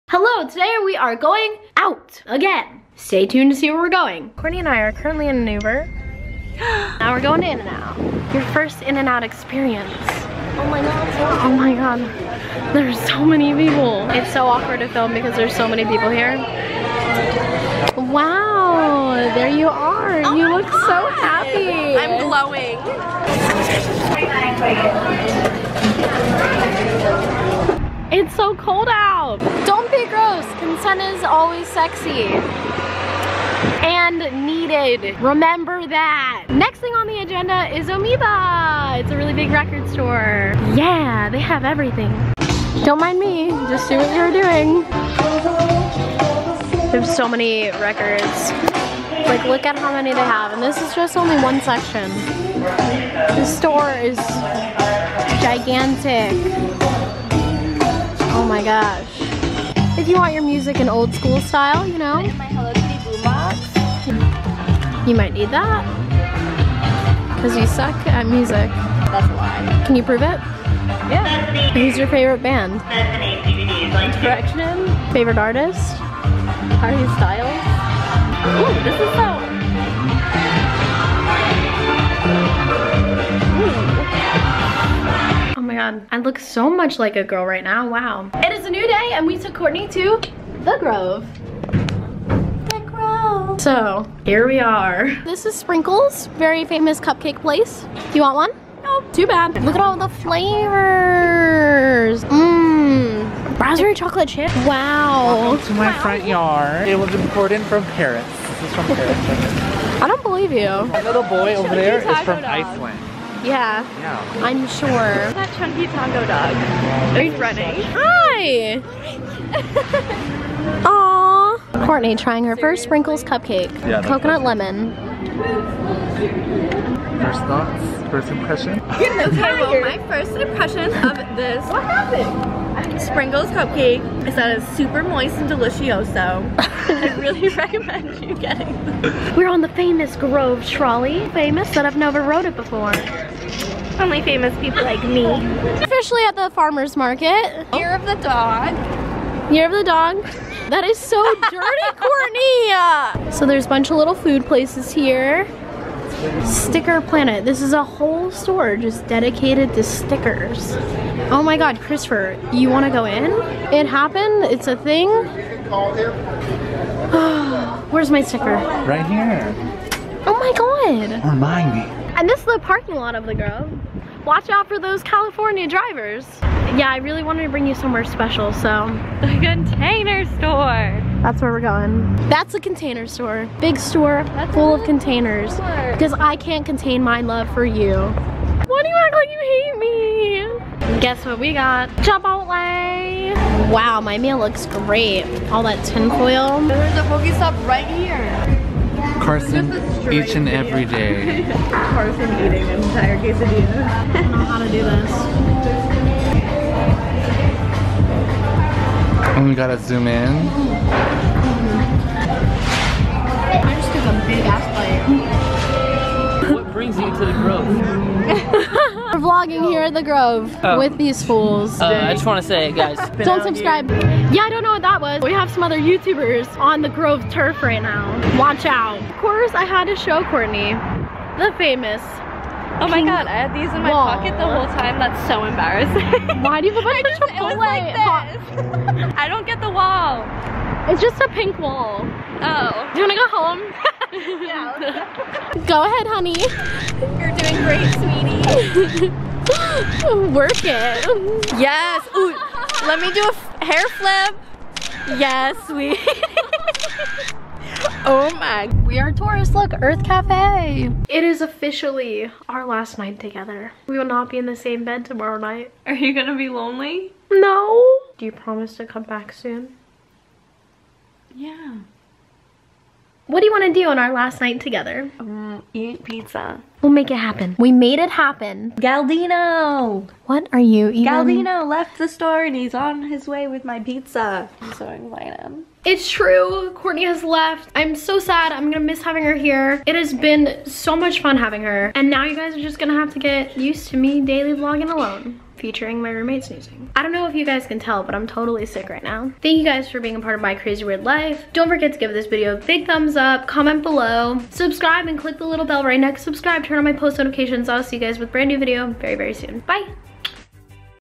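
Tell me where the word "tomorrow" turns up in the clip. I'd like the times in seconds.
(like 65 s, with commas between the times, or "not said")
265 s.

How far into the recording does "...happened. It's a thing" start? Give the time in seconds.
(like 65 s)
163 s.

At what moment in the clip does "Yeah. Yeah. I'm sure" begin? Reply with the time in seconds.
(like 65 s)
113 s.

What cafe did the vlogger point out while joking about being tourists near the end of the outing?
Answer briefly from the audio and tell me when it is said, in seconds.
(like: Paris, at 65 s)
Earth Cafe, at 259 s.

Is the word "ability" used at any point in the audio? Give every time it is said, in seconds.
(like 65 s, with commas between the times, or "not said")
not said.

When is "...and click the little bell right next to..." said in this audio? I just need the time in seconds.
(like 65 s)
305 s.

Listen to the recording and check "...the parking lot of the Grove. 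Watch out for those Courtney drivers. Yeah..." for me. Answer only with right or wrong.
wrong.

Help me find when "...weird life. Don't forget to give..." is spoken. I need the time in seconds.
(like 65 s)
300 s.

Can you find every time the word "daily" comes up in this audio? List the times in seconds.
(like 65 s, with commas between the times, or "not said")
294 s.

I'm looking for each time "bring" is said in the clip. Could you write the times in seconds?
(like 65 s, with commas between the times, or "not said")
177 s, 216 s.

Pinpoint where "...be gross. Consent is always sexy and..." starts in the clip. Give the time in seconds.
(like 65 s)
29 s.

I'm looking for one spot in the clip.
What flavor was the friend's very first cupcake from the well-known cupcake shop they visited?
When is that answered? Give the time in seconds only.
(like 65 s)
124 s.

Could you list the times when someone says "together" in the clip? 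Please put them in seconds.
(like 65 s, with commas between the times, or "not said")
263 s, 274 s.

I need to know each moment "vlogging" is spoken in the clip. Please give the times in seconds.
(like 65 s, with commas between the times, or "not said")
219 s, 294 s.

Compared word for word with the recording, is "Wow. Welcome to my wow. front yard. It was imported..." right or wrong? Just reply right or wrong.
right.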